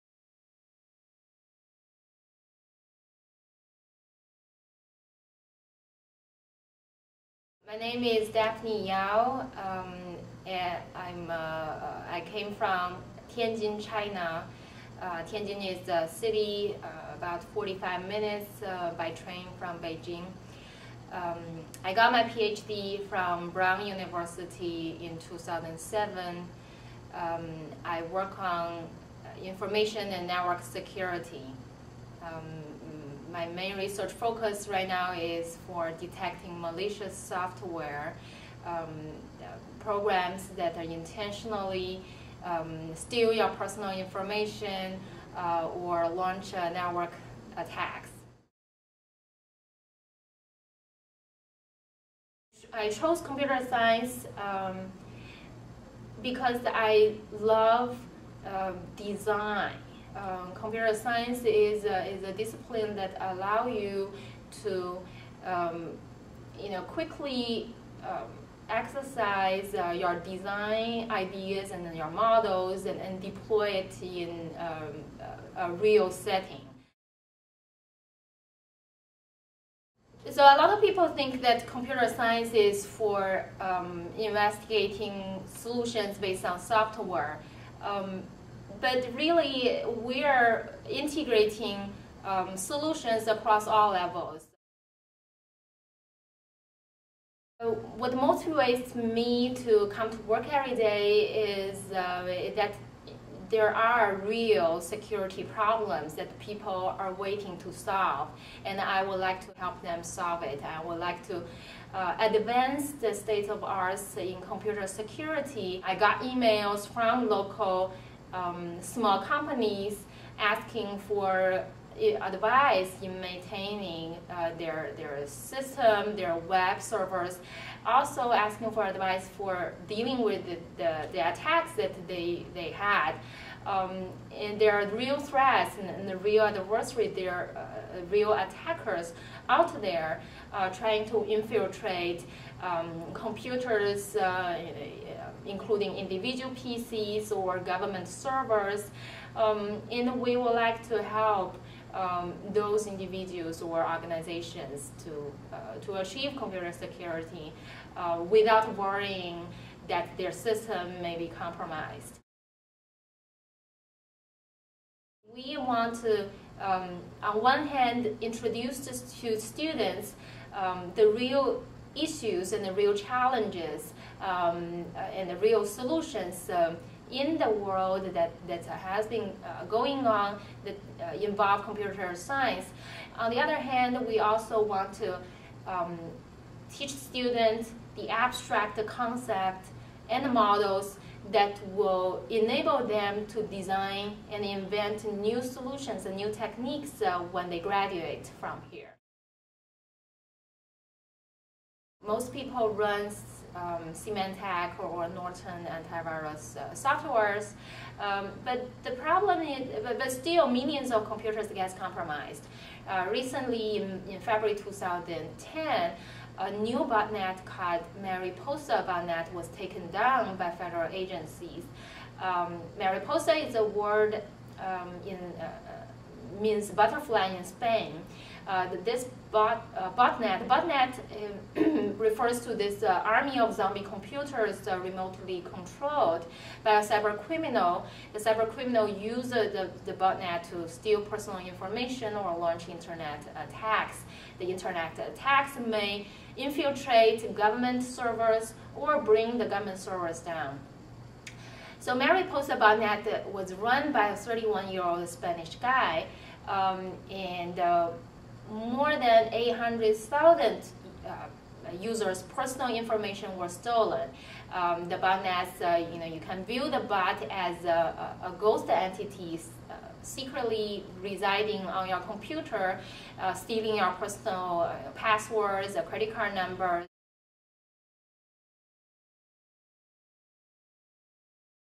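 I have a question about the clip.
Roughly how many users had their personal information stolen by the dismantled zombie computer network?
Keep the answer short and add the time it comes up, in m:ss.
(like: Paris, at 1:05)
800,000, at 4:19.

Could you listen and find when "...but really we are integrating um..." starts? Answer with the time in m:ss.
1:28.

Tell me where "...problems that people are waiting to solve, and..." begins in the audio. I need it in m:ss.
1:45.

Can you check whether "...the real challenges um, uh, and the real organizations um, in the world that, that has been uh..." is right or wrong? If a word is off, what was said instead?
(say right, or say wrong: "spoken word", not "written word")
wrong: "solutions", not "organizations".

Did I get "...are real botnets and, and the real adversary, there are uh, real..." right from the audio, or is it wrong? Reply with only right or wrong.
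wrong.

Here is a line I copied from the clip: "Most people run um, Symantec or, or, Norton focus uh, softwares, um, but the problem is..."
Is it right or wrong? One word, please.
wrong.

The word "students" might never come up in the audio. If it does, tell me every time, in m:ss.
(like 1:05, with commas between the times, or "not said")
2:49, 3:06.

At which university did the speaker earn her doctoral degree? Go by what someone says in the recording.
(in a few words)
Brown University.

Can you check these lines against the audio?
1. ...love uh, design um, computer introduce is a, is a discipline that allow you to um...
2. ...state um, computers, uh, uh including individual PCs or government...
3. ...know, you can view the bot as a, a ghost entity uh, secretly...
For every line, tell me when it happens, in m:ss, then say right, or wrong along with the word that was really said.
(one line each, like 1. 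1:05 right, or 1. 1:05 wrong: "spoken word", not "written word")
1. 0:57 wrong: "science", not "introduce"
2. 2:21 wrong: "infiltrate", not "state"
3. 4:25 right.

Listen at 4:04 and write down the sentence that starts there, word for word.
The internet attacks may infiltrate government servers or bring the government servers down.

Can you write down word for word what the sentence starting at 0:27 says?
Um, I work on uh, information and network security.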